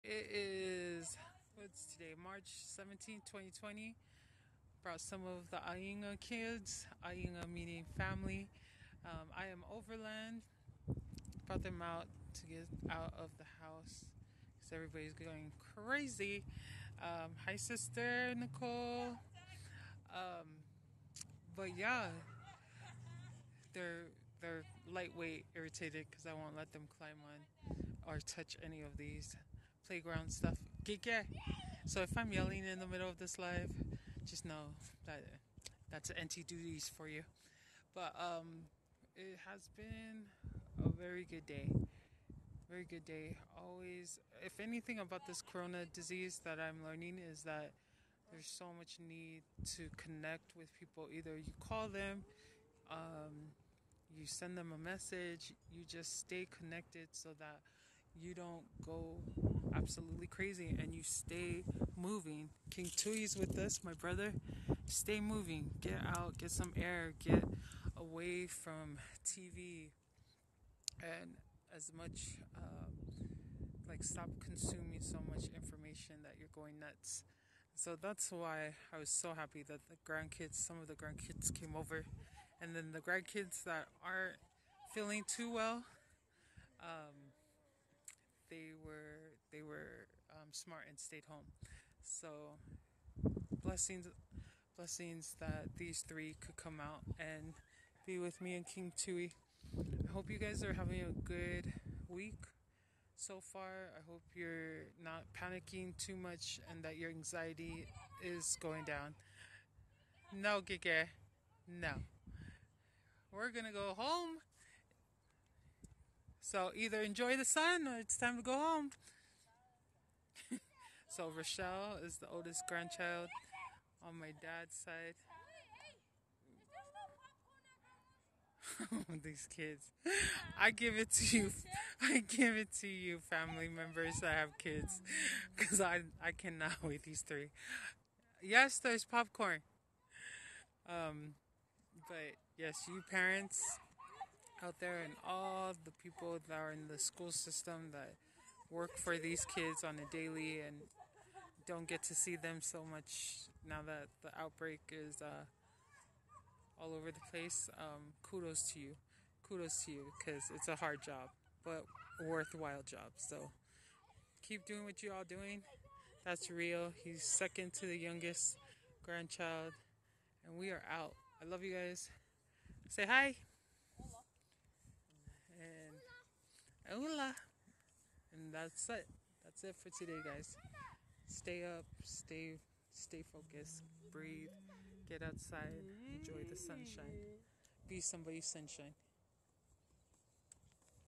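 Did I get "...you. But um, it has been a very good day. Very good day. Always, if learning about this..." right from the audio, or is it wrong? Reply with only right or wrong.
wrong.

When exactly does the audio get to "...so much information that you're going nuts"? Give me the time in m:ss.
1:15.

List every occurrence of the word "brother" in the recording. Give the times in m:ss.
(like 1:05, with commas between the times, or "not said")
1:03.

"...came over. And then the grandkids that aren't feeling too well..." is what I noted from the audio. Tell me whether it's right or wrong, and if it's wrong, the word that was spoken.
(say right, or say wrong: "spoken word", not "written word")
right.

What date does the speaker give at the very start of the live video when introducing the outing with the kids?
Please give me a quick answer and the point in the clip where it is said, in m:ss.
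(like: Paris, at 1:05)
March 17, 2020, at 0:02.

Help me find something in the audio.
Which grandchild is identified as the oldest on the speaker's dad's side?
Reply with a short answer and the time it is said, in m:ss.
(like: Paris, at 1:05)
Rochelle, at 2:01.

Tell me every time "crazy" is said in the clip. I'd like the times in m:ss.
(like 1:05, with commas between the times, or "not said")
0:15, 1:00.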